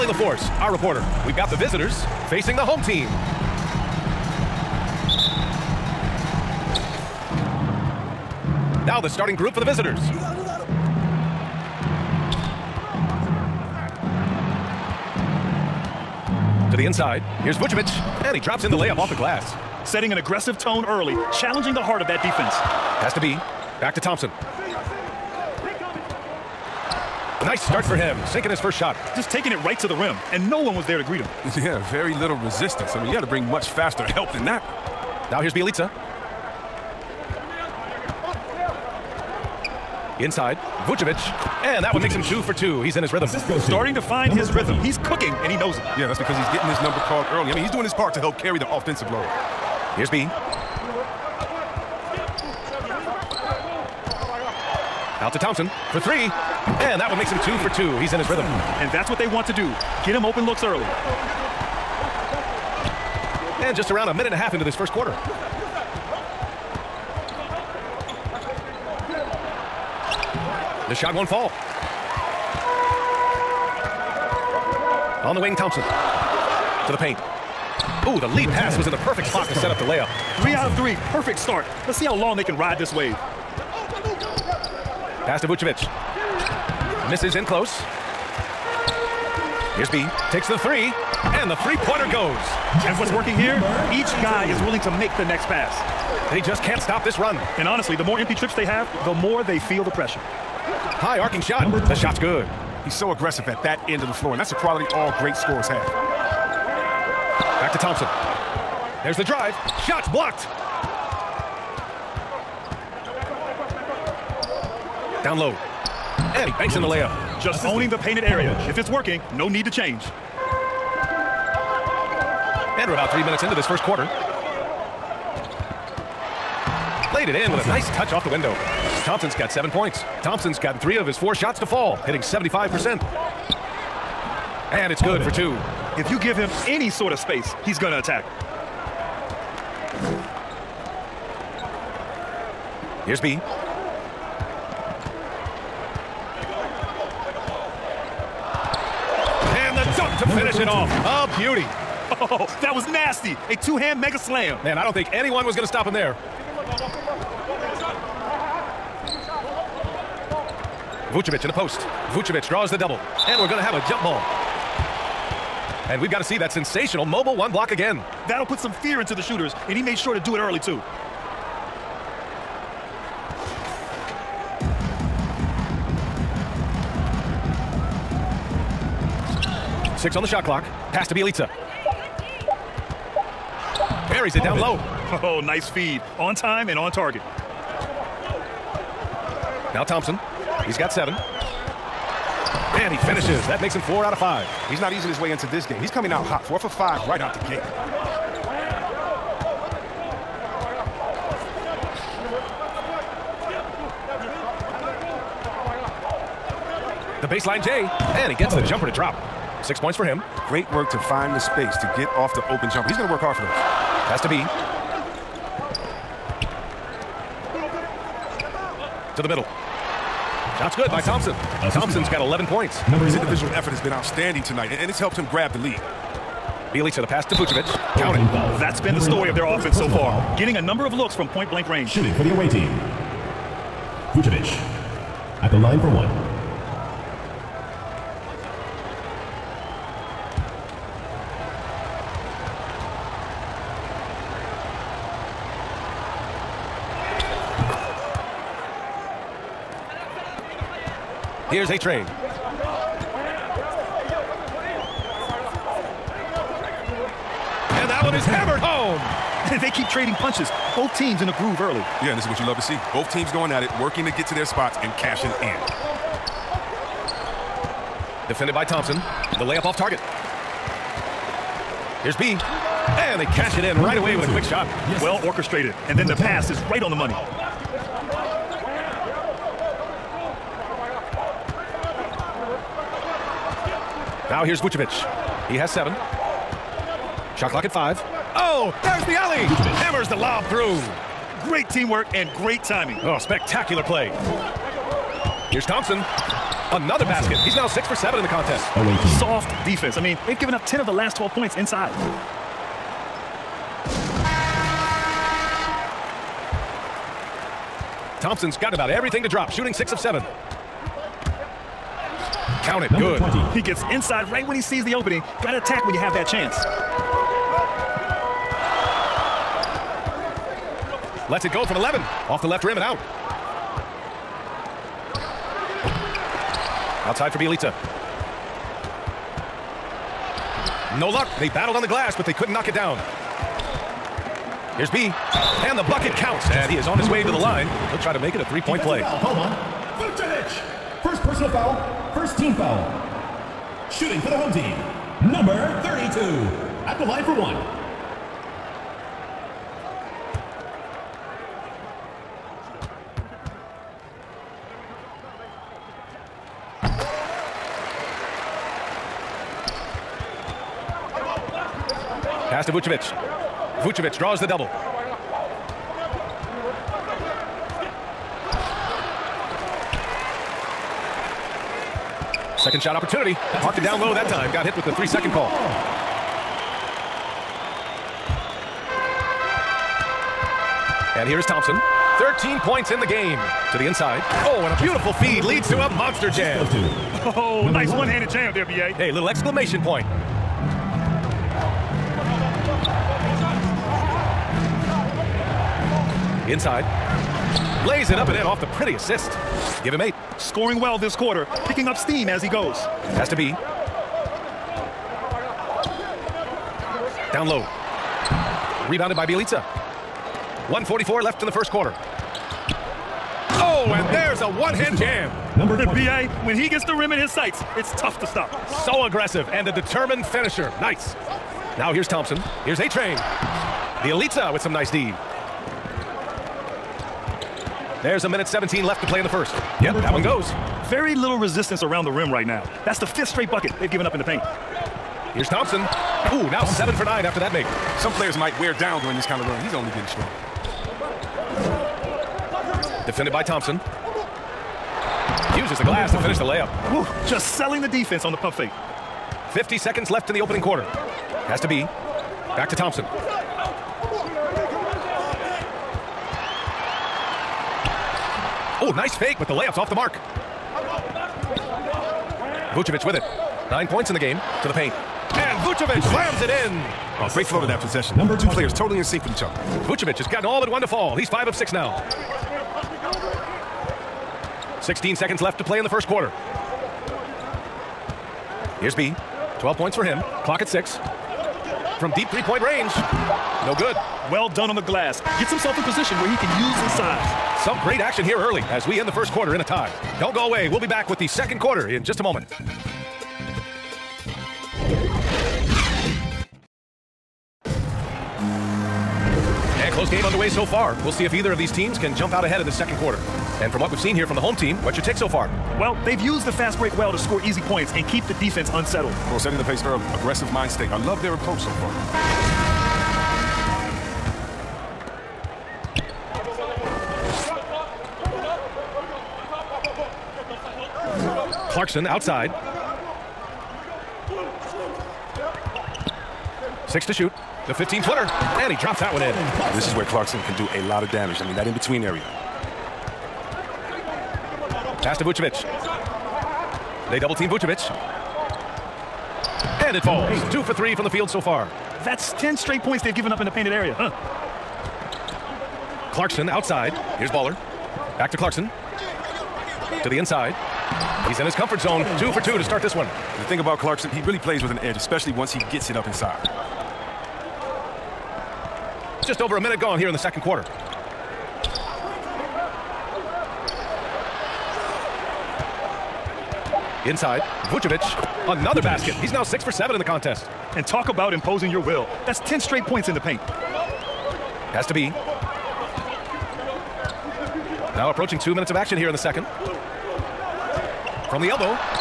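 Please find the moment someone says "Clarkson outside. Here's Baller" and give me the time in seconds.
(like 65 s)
546 s.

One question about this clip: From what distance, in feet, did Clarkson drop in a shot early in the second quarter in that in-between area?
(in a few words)
15 feet.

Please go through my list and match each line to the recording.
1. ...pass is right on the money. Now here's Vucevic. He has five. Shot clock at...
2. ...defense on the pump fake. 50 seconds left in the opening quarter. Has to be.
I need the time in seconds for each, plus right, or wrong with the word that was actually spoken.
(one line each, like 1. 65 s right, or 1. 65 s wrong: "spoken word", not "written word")
1. 276 s wrong: "seven", not "five"
2. 447 s right.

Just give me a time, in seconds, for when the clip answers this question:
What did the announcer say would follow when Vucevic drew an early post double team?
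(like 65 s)
163 s.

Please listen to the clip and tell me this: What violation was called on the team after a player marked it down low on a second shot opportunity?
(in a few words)
three-second call.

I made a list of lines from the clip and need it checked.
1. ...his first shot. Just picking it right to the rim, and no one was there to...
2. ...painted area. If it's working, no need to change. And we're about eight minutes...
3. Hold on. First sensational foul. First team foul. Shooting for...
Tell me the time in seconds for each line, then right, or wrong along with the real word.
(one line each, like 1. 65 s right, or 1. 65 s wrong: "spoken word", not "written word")
1. 28 s wrong: "taking", not "picking"
2. 117 s wrong: "three", not "eight"
3. 339 s wrong: "personal", not "sensational".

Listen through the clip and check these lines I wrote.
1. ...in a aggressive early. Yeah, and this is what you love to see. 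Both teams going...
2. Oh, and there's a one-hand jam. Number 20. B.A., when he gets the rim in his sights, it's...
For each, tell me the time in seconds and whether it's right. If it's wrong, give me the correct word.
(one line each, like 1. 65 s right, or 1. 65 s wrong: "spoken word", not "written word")
1. 261 s wrong: "groove", not "aggressive"
2. 413 s right.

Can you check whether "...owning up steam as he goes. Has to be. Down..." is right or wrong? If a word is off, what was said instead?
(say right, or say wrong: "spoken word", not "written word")
wrong: "picking", not "owning".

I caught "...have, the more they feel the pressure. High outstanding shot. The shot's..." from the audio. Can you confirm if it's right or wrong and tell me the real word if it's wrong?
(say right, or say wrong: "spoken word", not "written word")
wrong: "arcing", not "outstanding".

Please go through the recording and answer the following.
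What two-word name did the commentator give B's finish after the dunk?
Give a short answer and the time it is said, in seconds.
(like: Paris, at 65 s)
mega slam, at 153 s.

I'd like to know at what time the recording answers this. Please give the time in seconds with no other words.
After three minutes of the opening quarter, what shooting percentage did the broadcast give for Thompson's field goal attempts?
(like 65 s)
132 s.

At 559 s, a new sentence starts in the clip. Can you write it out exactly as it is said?
just over a minute gone here in the second quarter.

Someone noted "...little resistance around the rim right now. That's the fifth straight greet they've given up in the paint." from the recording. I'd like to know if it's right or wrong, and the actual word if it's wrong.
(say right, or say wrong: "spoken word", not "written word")
wrong: "bucket", not "greet".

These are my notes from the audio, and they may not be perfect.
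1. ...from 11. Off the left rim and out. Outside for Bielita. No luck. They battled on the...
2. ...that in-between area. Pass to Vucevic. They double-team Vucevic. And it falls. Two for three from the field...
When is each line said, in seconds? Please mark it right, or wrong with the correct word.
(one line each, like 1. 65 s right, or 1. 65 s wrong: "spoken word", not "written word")
1. 321 s right
2. 531 s right.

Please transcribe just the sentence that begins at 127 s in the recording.
Laid it in with a nice touch off the window.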